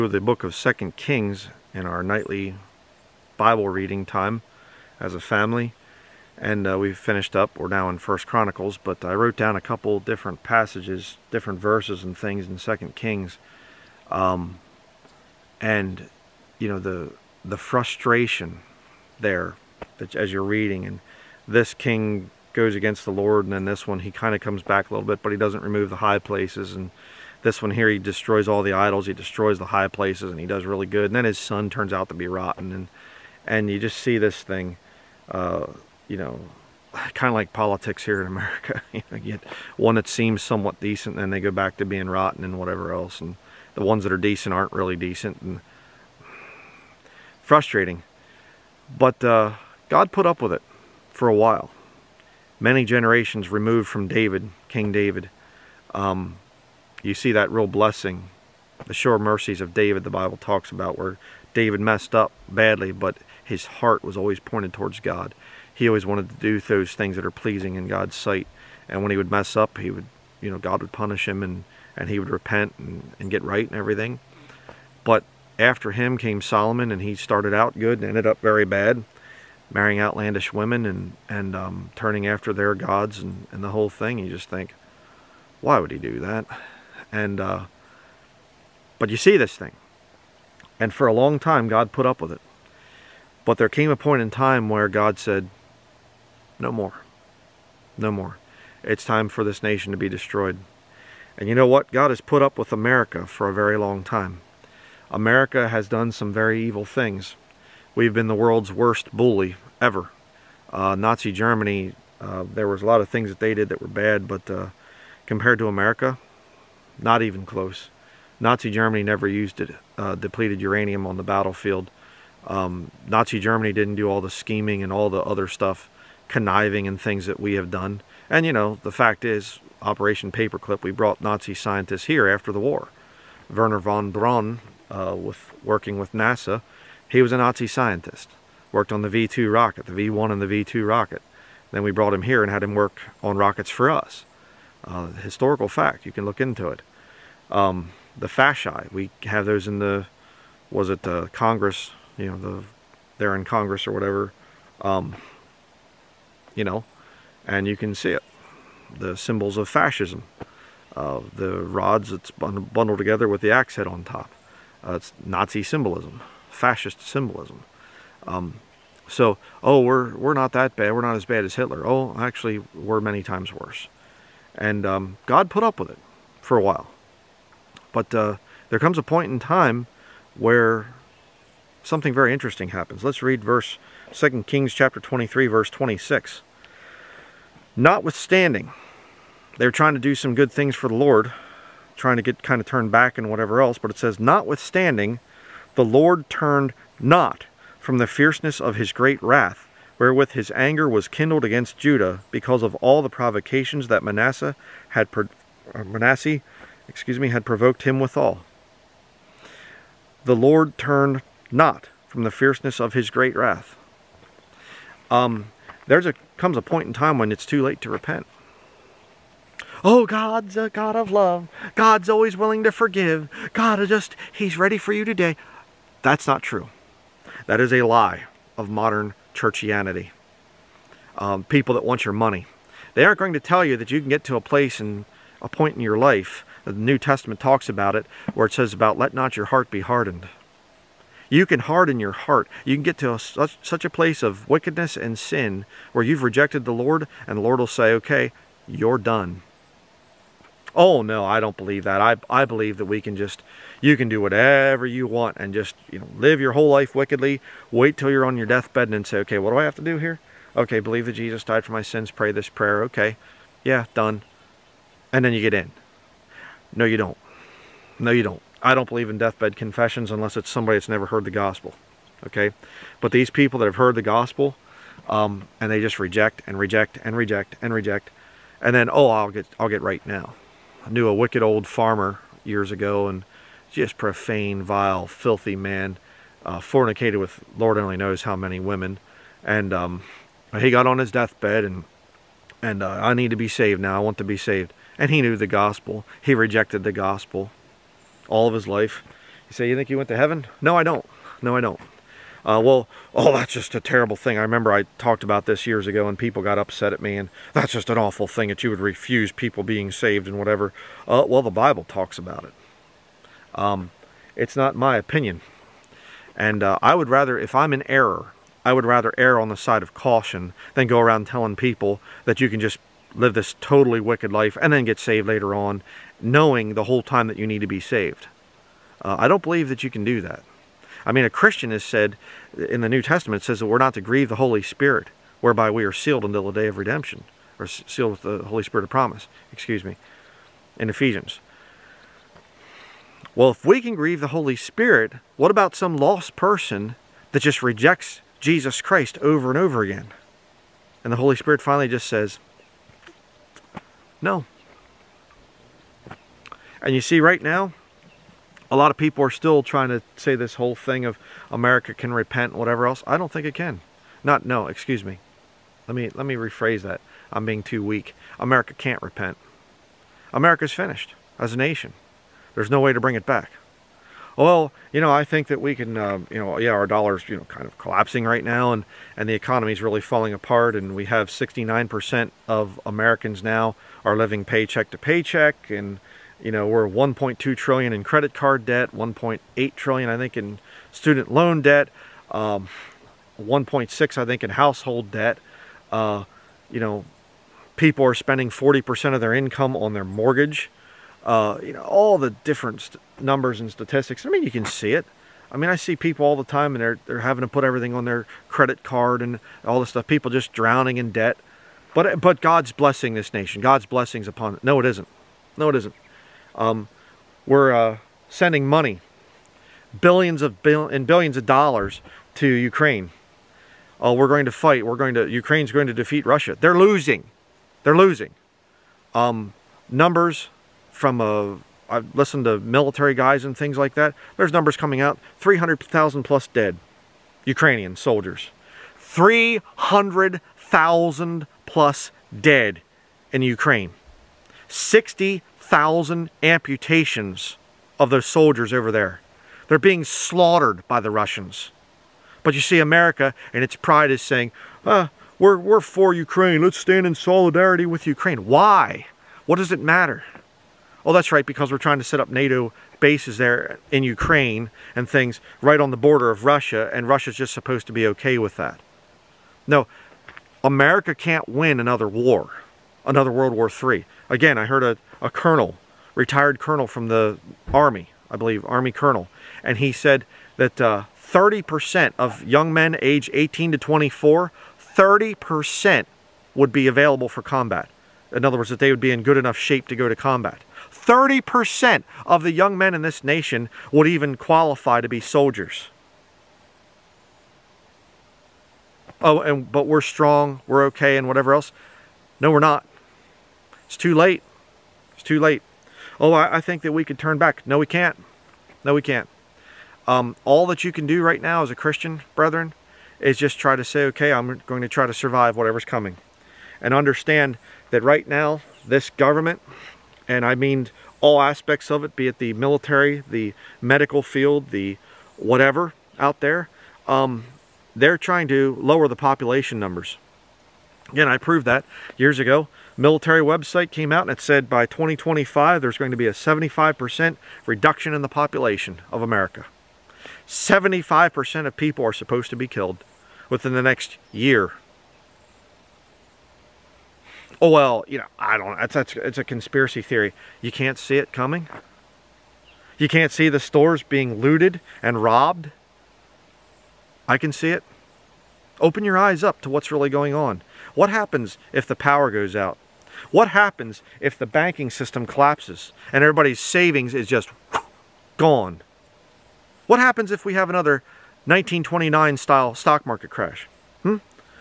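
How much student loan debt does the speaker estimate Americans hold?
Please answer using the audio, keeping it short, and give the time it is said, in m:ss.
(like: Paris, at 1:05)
1.8 trillion, at 6:28.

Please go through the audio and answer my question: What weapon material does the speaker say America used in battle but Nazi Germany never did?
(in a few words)
Depleted uranium.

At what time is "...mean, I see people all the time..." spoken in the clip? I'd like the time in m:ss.
6:45.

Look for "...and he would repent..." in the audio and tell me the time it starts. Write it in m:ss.
1:11.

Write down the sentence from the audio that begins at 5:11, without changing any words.
Uh, well, the Bible talks about it.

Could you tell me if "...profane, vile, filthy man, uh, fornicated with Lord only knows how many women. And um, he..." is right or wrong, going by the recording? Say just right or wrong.
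right.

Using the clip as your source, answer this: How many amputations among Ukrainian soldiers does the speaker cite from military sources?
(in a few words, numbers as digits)
60,000.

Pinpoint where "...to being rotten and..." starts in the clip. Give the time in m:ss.
0:41.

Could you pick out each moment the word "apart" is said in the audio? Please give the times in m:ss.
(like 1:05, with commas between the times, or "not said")
6:20.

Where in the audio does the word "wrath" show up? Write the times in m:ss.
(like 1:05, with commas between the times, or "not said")
3:19, 3:33.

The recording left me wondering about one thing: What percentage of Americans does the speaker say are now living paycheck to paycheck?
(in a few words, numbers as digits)
69%.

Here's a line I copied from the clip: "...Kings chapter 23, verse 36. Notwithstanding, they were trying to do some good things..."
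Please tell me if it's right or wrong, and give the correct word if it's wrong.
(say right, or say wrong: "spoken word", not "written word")
wrong: "26", not "36".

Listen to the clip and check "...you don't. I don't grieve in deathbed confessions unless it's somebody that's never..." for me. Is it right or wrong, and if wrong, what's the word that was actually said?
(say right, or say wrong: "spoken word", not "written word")
wrong: "believe", not "grieve".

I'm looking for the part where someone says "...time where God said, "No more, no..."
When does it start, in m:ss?
1:34.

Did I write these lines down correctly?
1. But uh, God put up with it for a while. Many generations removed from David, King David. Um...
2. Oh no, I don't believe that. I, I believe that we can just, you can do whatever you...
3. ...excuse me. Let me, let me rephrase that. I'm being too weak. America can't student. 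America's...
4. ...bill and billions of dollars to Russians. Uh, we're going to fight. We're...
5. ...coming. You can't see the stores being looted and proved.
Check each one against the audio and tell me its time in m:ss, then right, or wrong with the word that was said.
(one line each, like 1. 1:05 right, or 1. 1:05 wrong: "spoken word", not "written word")
1. 0:48 right
2. 4:10 right
3. 6:04 wrong: "repent", not "student"
4. 7:00 wrong: "Ukraine", not "Russians"
5. 9:11 wrong: "robbed", not "proved".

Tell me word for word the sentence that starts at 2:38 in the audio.
The symbols of fascism, uh, the rods that's bundled together with the axe head on top.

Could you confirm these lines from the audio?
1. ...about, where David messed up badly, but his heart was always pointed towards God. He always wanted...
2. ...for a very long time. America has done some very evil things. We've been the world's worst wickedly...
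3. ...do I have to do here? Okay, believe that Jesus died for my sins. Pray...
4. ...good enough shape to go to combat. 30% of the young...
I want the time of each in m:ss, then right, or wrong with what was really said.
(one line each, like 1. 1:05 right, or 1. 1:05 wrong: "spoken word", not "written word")
1. 1:00 right
2. 1:43 wrong: "bully", not "wickedly"
3. 4:19 right
4. 8:09 right.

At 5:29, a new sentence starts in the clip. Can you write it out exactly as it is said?
Uh, I don't believe that you can do that.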